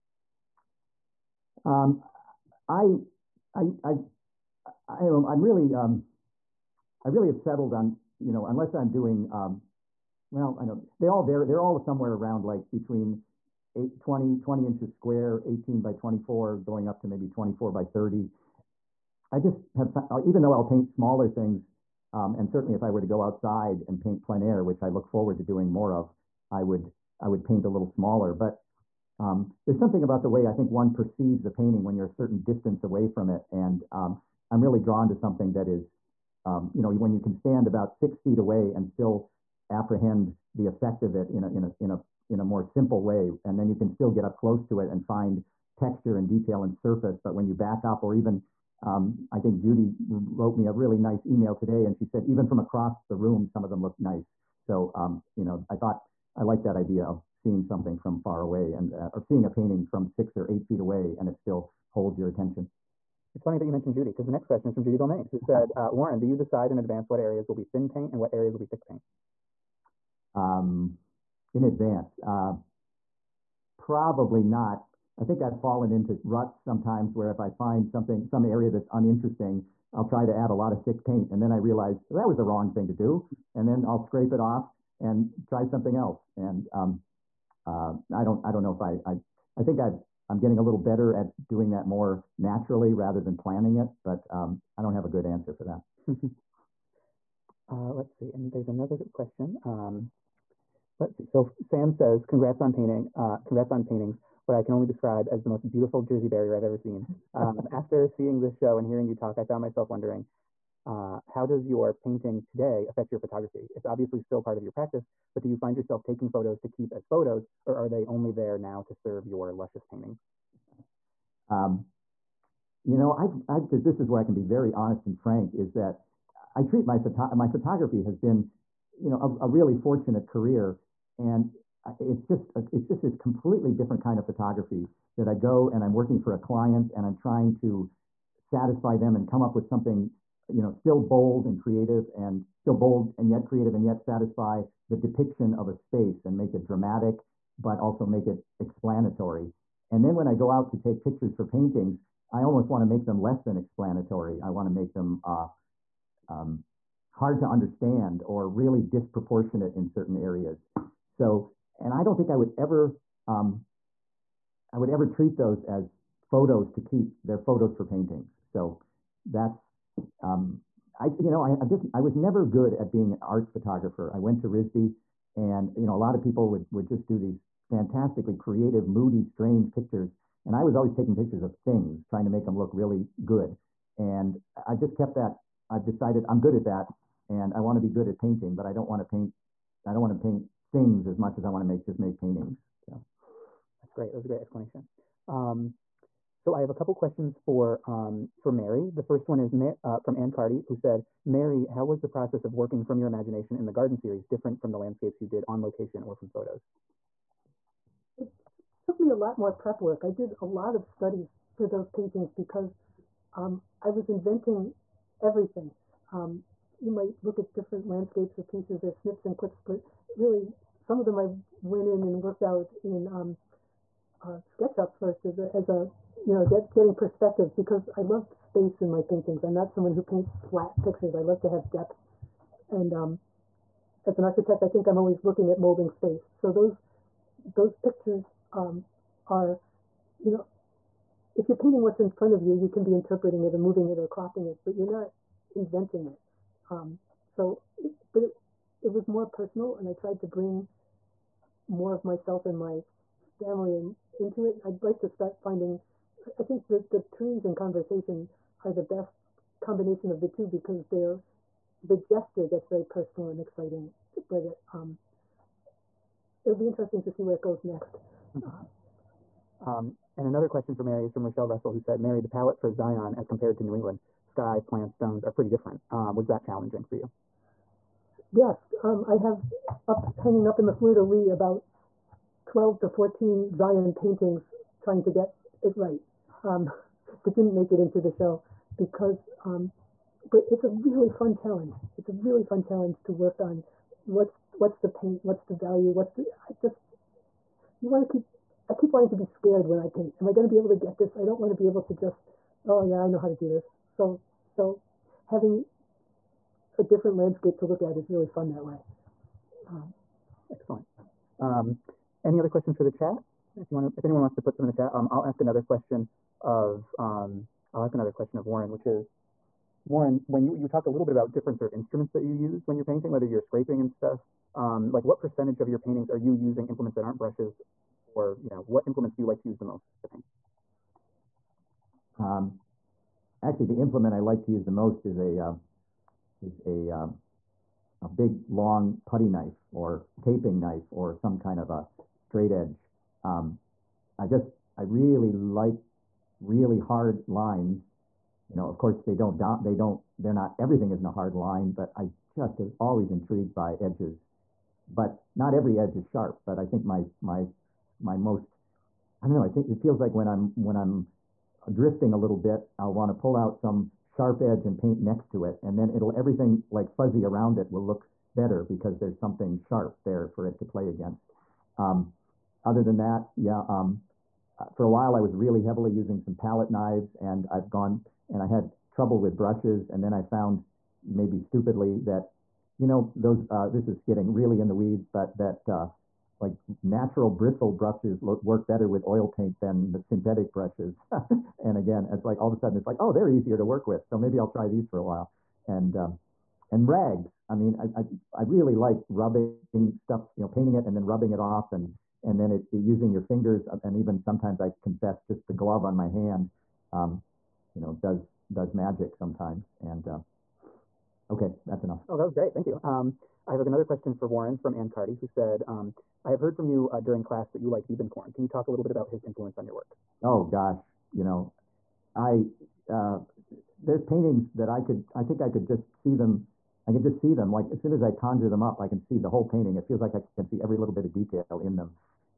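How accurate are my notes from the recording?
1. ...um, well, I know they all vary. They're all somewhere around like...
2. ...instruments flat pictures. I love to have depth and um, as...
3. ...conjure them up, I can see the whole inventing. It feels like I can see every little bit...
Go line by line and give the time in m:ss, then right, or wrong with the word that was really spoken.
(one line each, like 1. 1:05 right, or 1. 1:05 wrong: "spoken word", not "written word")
1. 0:09 right
2. 3:50 wrong: "paints", not "instruments"
3. 7:08 wrong: "painting", not "inventing".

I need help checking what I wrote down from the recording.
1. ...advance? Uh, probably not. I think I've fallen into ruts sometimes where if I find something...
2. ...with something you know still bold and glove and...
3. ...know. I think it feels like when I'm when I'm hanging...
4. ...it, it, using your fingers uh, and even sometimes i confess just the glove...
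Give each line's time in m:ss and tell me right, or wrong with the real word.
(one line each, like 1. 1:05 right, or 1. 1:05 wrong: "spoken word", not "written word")
1. 1:11 right
2. 2:19 wrong: "creative", not "glove"
3. 5:59 wrong: "drifting", not "hanging"
4. 6:42 right.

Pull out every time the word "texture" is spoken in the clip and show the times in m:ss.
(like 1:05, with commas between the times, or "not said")
0:45.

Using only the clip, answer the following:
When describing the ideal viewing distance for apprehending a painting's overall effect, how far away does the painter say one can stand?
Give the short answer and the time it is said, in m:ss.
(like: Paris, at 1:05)
6 feet, at 0:37.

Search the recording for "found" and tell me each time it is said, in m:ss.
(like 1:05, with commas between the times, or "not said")
0:19, 1:49, 6:20.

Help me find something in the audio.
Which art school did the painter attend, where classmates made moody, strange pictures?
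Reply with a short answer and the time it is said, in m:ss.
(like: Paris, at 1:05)
RISD, at 2:54.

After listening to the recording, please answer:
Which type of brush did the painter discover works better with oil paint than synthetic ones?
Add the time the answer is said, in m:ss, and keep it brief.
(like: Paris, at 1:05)
natural bristle, at 6:26.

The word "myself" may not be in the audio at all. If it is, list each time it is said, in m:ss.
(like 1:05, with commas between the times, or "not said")
1:49, 4:12.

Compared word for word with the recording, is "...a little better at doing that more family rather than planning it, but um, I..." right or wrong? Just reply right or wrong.
wrong.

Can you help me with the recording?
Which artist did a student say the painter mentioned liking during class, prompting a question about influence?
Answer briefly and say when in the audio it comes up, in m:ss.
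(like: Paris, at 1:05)
Diebenkorn, at 6:57.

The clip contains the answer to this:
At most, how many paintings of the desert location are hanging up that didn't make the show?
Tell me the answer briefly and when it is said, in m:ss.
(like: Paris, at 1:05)
14, at 4:42.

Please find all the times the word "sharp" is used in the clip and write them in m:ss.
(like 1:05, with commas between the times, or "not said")
5:56, 6:04, 6:09.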